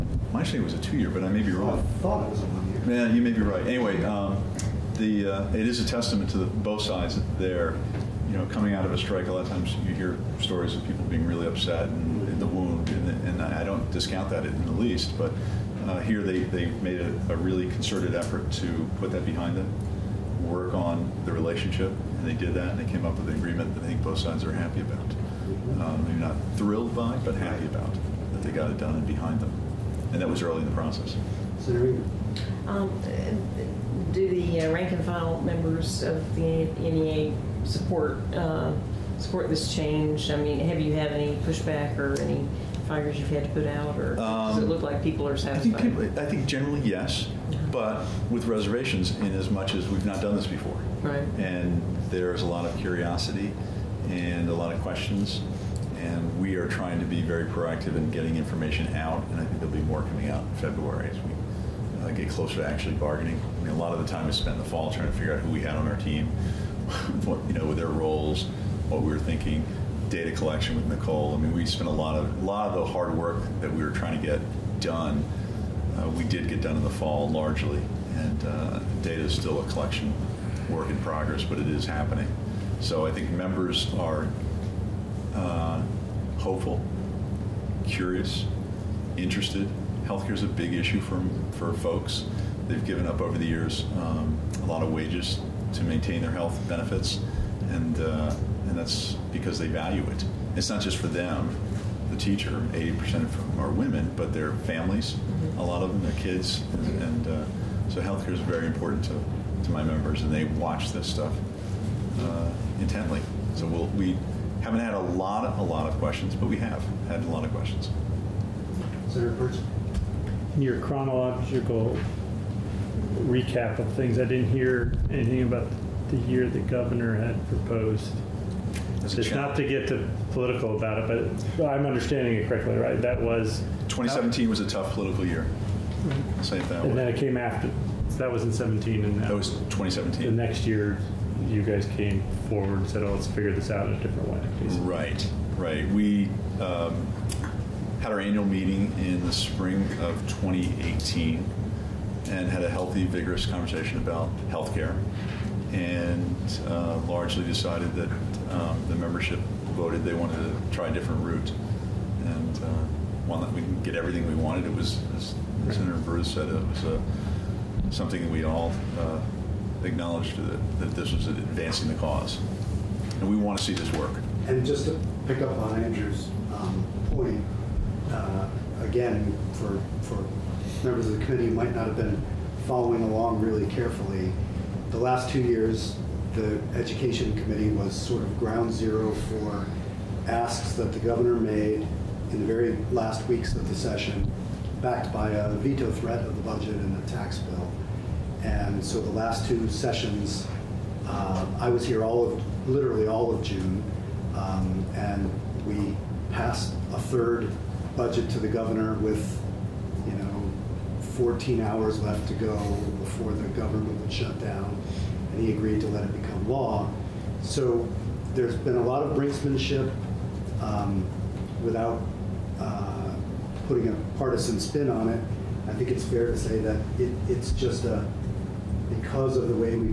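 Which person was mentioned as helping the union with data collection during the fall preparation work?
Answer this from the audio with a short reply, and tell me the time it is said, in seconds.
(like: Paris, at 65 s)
Nicole, at 70 s.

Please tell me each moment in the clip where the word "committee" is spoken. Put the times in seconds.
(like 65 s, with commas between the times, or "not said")
181 s, 187 s.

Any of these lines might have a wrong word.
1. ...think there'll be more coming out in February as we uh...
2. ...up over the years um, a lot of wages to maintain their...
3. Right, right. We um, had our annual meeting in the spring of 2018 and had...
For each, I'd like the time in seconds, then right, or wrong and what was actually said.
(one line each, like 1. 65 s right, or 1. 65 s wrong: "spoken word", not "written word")
1. 59 s right
2. 93 s right
3. 144 s right.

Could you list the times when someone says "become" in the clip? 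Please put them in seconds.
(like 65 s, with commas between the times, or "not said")
216 s.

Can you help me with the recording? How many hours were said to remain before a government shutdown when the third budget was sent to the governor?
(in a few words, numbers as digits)
14.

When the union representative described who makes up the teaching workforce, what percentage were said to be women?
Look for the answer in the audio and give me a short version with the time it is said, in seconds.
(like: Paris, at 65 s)
80%, at 102 s.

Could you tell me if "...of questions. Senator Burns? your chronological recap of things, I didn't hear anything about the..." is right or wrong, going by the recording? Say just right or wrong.
right.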